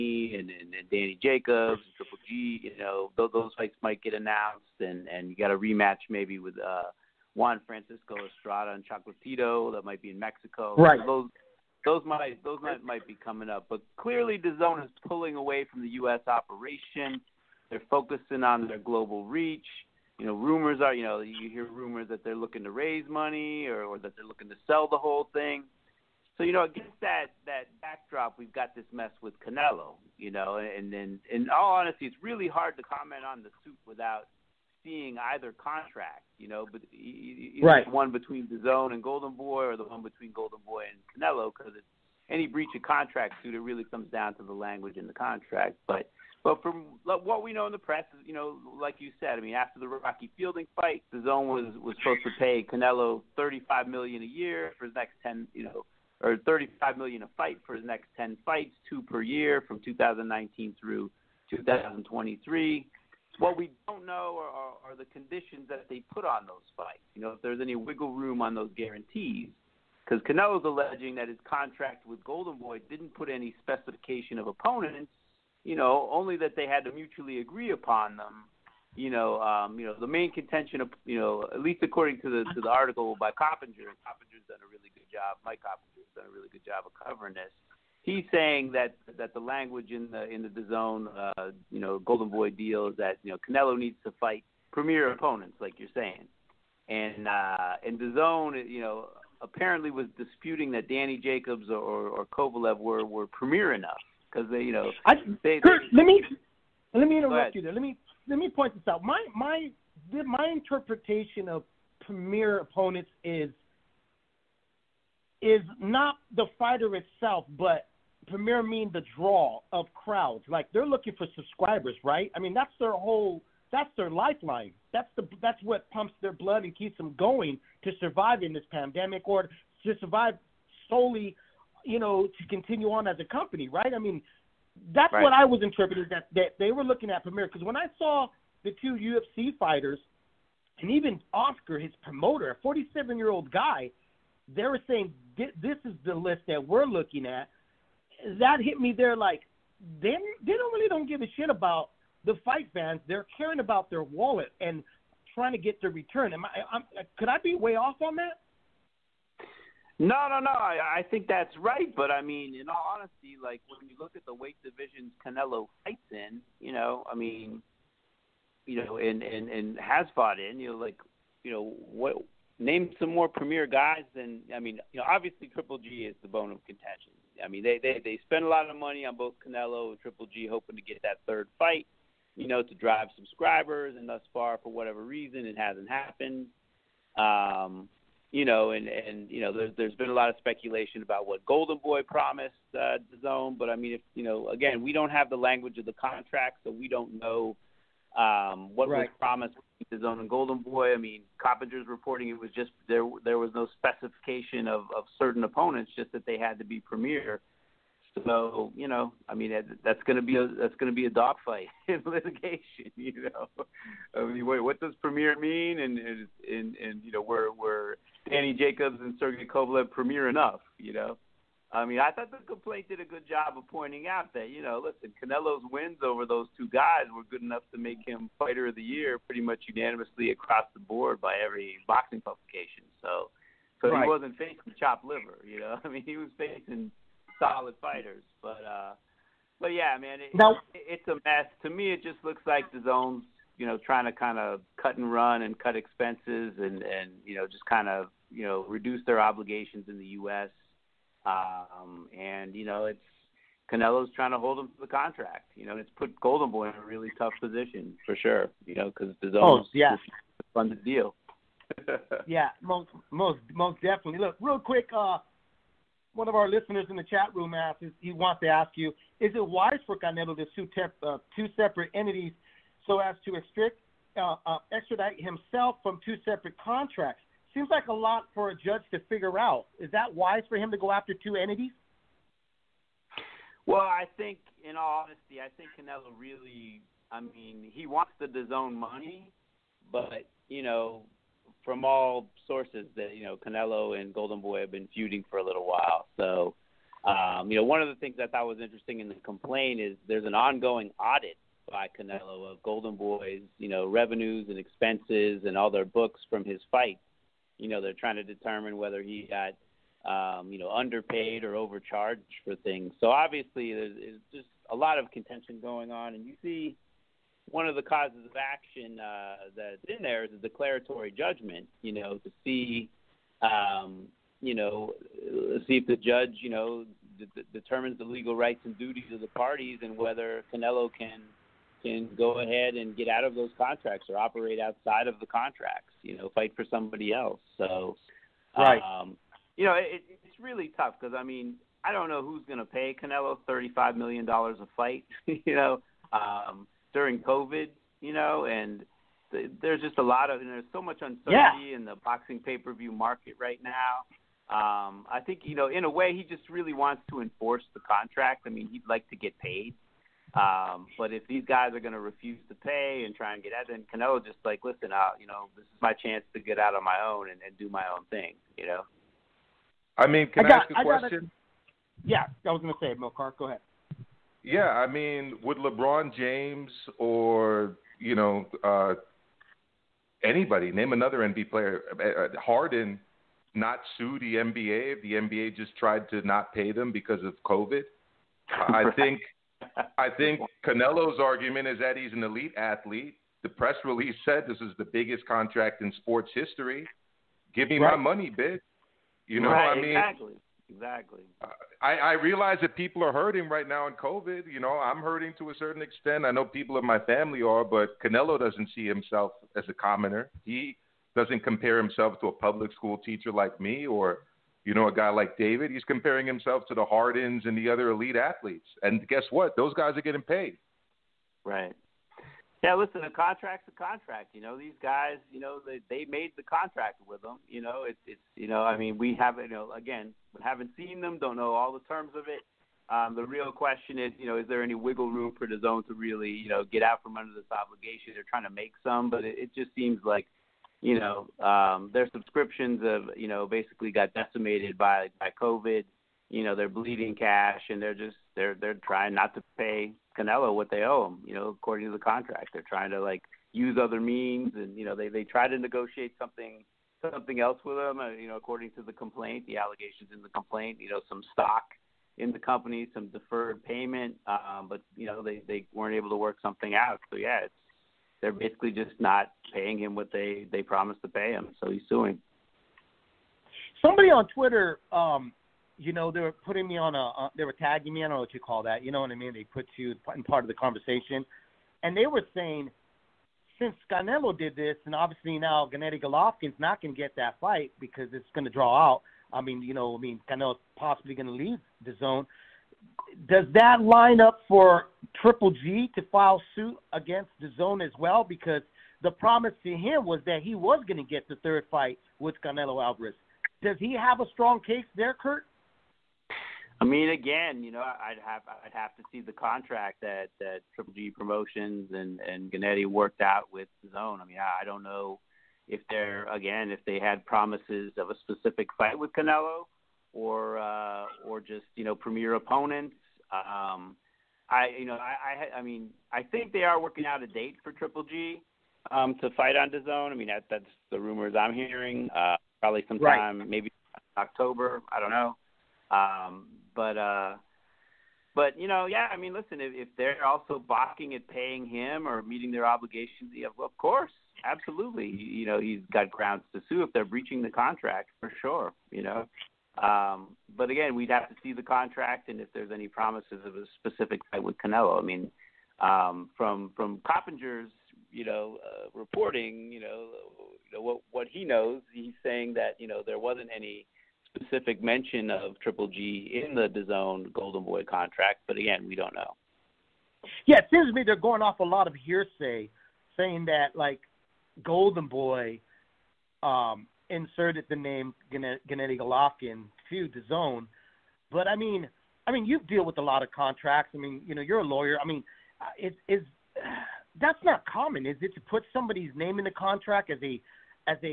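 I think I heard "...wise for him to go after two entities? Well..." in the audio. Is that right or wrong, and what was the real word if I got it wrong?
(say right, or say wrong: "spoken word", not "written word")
right.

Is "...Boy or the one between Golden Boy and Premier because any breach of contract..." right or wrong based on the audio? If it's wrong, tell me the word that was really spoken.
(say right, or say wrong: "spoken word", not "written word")
wrong: "Canelo", not "Premier".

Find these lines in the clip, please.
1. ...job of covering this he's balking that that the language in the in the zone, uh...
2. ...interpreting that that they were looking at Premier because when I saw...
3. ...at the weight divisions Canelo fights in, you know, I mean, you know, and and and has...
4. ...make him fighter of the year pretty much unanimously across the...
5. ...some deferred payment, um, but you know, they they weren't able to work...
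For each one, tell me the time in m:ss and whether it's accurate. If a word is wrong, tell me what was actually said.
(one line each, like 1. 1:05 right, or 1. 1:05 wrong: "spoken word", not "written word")
1. 1:26 wrong: "saying", not "balking"
2. 2:15 right
3. 2:44 right
4. 3:47 right
5. 7:42 right.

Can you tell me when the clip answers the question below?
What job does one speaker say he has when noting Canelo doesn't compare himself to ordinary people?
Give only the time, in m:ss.
6:52.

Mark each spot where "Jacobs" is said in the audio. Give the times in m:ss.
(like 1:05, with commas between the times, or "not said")
0:01, 1:41, 3:38.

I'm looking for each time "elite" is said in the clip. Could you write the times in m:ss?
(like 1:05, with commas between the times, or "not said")
6:32, 6:57.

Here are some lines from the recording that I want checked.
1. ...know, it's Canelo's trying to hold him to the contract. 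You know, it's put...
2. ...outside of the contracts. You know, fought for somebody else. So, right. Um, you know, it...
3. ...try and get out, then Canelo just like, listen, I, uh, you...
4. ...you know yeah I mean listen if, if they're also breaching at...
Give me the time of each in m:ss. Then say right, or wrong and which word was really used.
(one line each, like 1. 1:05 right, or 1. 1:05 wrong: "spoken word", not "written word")
1. 4:12 right
2. 5:34 wrong: "fight", not "fought"
3. 6:03 right
4. 8:58 wrong: "balking", not "breaching".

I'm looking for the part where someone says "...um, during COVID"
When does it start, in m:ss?
5:46.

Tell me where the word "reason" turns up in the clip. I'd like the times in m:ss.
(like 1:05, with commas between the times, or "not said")
3:05.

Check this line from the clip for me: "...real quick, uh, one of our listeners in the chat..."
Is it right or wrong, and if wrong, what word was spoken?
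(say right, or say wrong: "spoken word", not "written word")
right.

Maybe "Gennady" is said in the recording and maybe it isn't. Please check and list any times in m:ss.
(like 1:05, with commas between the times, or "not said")
8:05, 8:32, 9:38.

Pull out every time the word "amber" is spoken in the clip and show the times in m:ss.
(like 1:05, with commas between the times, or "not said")
not said.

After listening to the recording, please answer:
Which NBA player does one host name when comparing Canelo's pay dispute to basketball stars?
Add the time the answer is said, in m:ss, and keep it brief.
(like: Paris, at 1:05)
Harden, at 6:22.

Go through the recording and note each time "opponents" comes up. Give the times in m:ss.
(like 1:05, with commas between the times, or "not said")
1:14, 1:35, 1:52, 3:25, 8:42.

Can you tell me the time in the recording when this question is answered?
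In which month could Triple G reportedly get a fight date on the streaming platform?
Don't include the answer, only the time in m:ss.
8:54.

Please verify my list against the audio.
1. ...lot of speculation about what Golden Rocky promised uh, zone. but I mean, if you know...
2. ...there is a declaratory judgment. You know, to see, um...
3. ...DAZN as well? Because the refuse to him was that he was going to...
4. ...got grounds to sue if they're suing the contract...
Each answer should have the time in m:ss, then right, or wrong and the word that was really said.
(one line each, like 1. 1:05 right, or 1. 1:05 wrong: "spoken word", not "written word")
1. 3:10 wrong: "Boy", not "Rocky"
2. 5:20 right
3. 8:17 wrong: "promise", not "refuse"
4. 9:05 wrong: "breaching", not "suing".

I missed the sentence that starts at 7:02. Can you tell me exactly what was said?
Yeah, listen, a contract's a contract.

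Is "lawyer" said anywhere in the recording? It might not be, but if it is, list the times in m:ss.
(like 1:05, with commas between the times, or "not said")
9:44.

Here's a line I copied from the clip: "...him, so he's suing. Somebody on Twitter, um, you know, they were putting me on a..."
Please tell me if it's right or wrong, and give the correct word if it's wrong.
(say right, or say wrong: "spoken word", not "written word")
right.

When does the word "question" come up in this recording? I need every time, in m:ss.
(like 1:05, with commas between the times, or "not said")
6:10, 7:13.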